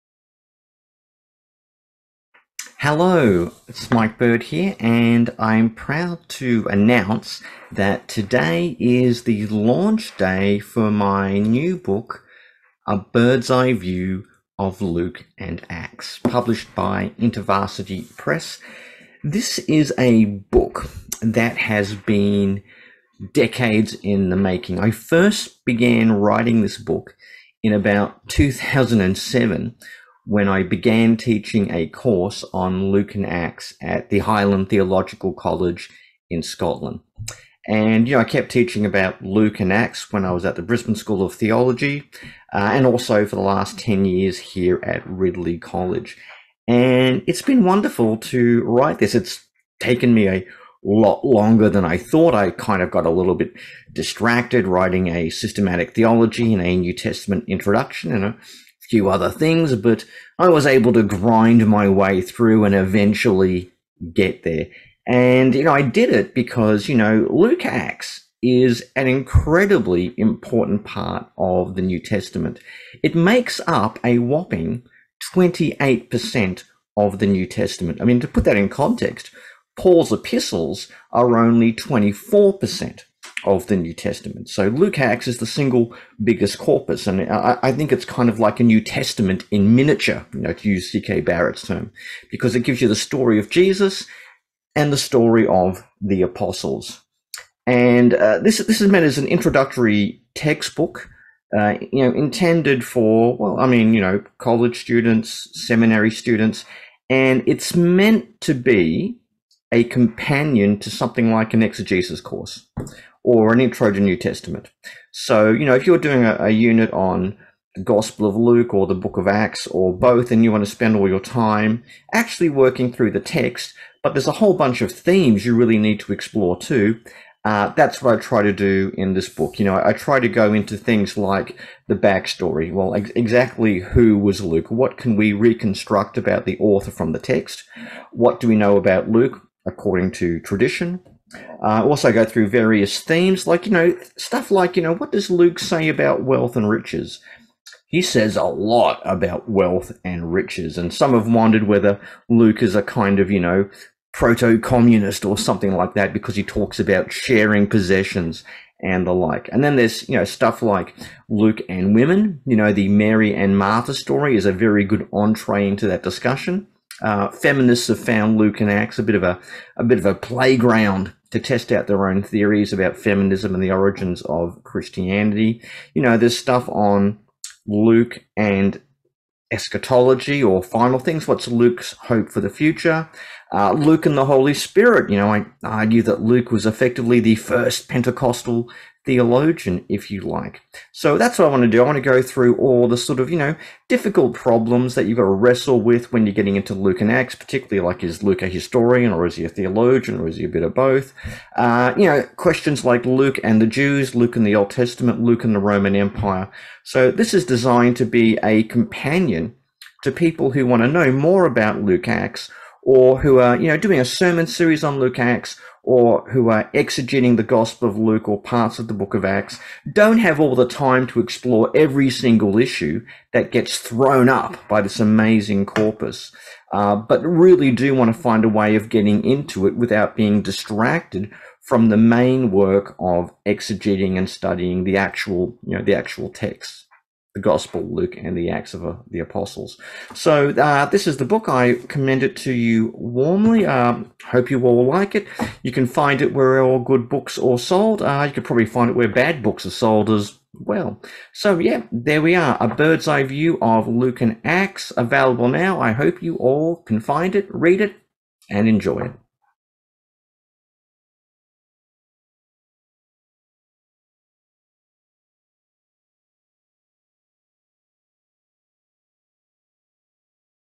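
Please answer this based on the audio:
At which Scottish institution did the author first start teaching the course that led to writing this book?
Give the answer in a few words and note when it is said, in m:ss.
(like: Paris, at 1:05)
Highland Theological College, at 0:34.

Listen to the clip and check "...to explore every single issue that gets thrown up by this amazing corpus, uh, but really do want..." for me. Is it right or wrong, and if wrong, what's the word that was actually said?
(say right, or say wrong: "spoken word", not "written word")
right.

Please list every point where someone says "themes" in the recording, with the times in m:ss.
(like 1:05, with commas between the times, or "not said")
2:04, 2:22.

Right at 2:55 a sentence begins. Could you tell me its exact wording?
You know, there's stuff on Luke and eschatology or final things.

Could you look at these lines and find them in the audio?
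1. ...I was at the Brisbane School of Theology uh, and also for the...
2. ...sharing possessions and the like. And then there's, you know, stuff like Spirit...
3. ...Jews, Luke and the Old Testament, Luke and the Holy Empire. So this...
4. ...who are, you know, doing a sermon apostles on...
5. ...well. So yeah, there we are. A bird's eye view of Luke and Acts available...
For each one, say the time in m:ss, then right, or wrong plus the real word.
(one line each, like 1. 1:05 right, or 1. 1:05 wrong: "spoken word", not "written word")
1. 0:40 right
2. 2:37 wrong: "Luke", not "Spirit"
3. 3:23 wrong: "Roman", not "Holy"
4. 3:33 wrong: "series", not "apostles"
5. 4:10 right.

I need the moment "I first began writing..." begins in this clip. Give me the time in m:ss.
0:24.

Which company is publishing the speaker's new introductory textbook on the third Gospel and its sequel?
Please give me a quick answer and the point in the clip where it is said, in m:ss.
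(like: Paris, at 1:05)
InterVarsity Press, at 0:17.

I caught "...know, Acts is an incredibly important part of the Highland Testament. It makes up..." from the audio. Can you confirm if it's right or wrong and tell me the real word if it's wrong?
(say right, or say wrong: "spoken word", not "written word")
wrong: "New", not "Highland".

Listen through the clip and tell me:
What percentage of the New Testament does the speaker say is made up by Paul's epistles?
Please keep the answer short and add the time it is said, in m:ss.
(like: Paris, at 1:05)
24%, at 1:21.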